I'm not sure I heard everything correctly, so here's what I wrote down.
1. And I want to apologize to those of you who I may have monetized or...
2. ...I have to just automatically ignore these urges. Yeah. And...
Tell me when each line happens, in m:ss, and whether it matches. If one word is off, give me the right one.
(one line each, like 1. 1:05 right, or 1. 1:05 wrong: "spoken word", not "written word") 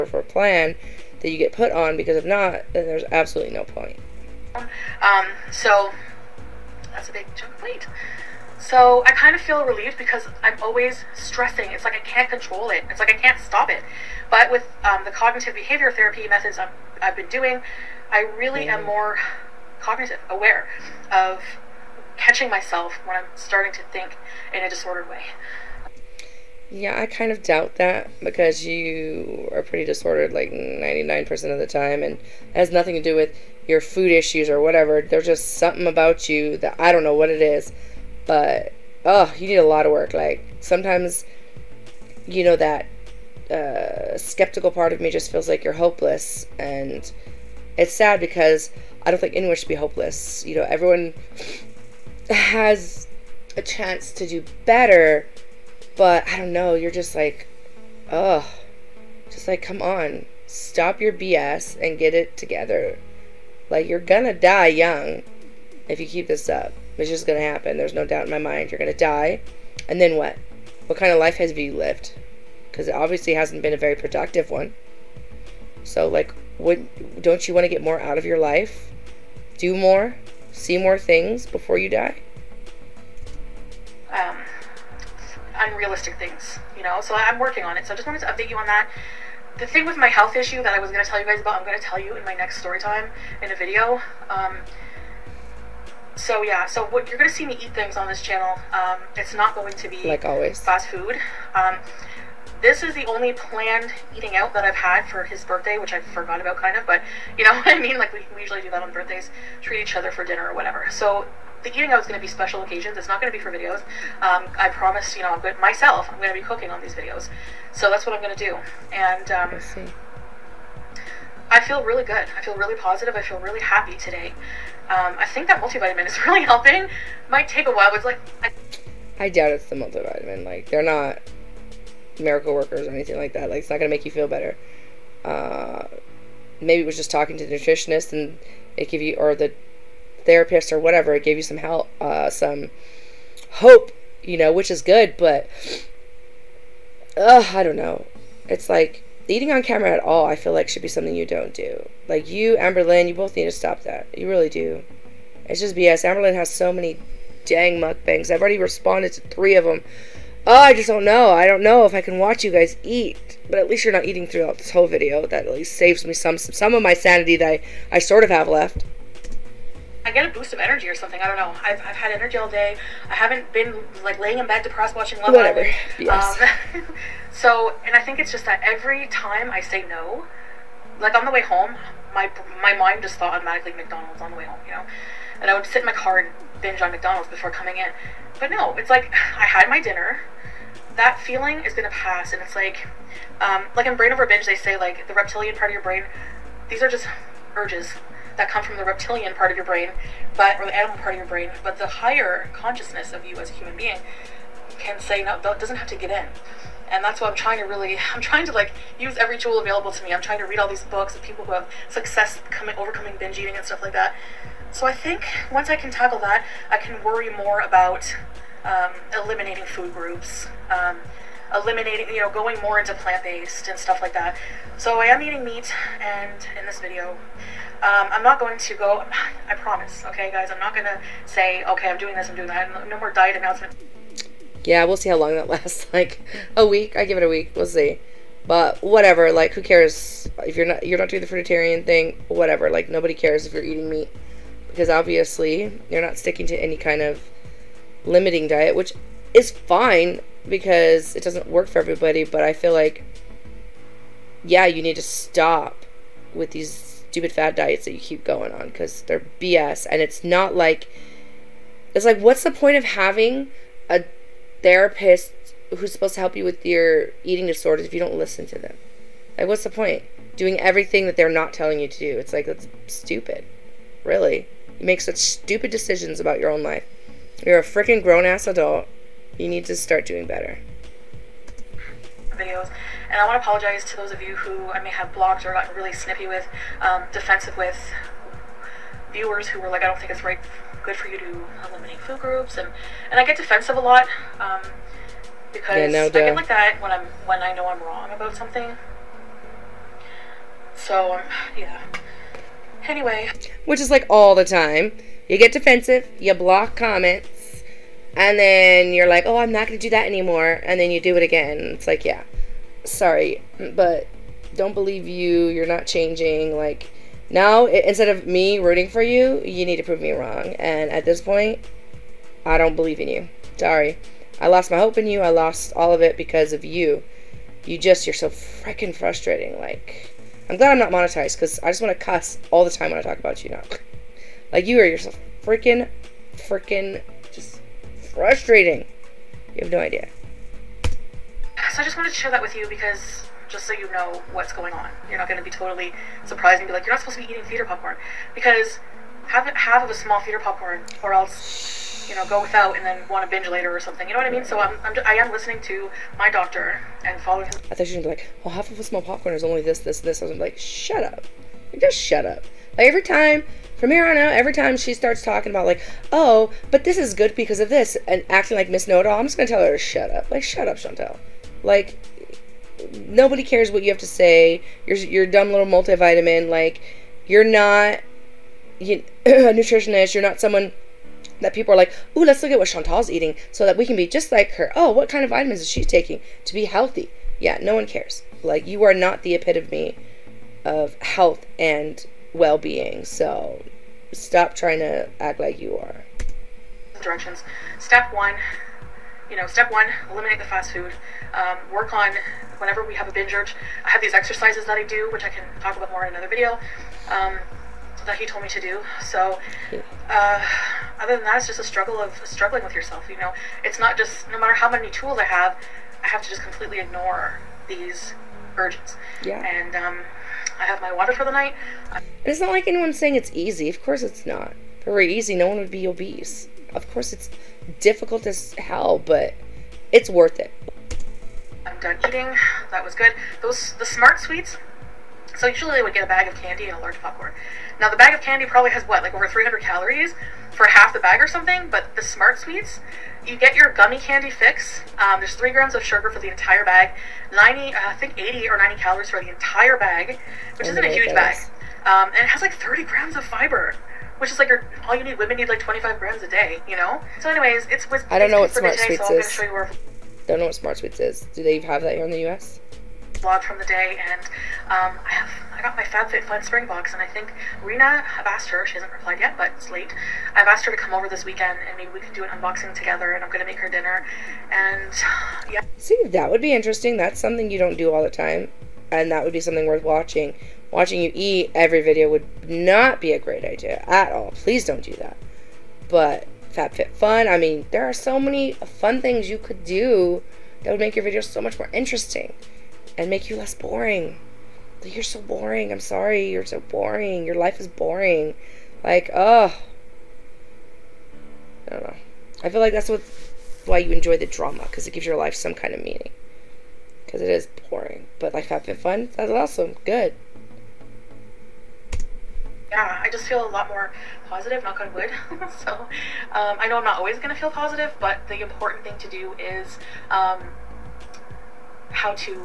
1. 4:43 wrong: "blocked", not "monetized"
2. 6:56 wrong: "completely", not "automatically".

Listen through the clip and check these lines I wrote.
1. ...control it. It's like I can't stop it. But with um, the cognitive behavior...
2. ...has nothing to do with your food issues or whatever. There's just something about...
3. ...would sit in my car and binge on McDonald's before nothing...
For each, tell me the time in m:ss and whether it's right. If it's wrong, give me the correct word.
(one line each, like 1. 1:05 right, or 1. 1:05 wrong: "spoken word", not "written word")
1. 0:12 right
2. 0:32 right
3. 3:05 wrong: "coming", not "nothing".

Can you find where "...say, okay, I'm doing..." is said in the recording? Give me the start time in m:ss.
3:51.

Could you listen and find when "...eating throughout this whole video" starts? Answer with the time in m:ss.
2:44.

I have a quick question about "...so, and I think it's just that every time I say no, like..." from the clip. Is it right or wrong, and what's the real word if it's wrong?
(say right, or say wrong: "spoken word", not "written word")
right.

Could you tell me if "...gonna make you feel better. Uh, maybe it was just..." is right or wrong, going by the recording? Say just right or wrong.
right.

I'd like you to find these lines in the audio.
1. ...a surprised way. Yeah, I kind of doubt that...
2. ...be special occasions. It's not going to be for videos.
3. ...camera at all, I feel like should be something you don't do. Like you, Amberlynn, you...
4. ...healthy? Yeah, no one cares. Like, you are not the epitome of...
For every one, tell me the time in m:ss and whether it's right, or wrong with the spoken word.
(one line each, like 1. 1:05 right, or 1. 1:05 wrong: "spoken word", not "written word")
1. 0:24 wrong: "disordered", not "surprised"
2. 1:52 right
3. 2:29 right
4. 6:26 right.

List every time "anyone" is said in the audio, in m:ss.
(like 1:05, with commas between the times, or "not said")
0:49, 7:02.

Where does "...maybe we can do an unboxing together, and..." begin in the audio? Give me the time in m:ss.
7:51.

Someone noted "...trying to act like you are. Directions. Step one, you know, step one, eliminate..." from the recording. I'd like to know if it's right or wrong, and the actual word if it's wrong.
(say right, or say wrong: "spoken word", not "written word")
right.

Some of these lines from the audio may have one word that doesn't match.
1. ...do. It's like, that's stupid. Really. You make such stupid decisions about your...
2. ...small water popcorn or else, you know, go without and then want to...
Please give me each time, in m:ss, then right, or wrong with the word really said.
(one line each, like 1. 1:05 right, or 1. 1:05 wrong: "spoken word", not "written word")
1. 4:31 right
2. 5:49 wrong: "theater", not "water".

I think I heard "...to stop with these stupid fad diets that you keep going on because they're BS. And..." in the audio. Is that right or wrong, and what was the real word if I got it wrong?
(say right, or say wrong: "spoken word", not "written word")
right.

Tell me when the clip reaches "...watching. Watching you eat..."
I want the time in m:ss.
7:59.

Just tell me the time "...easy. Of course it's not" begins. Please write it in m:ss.
7:03.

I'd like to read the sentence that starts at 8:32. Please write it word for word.
Yeah, I just feel a lot more positive, knock on wood.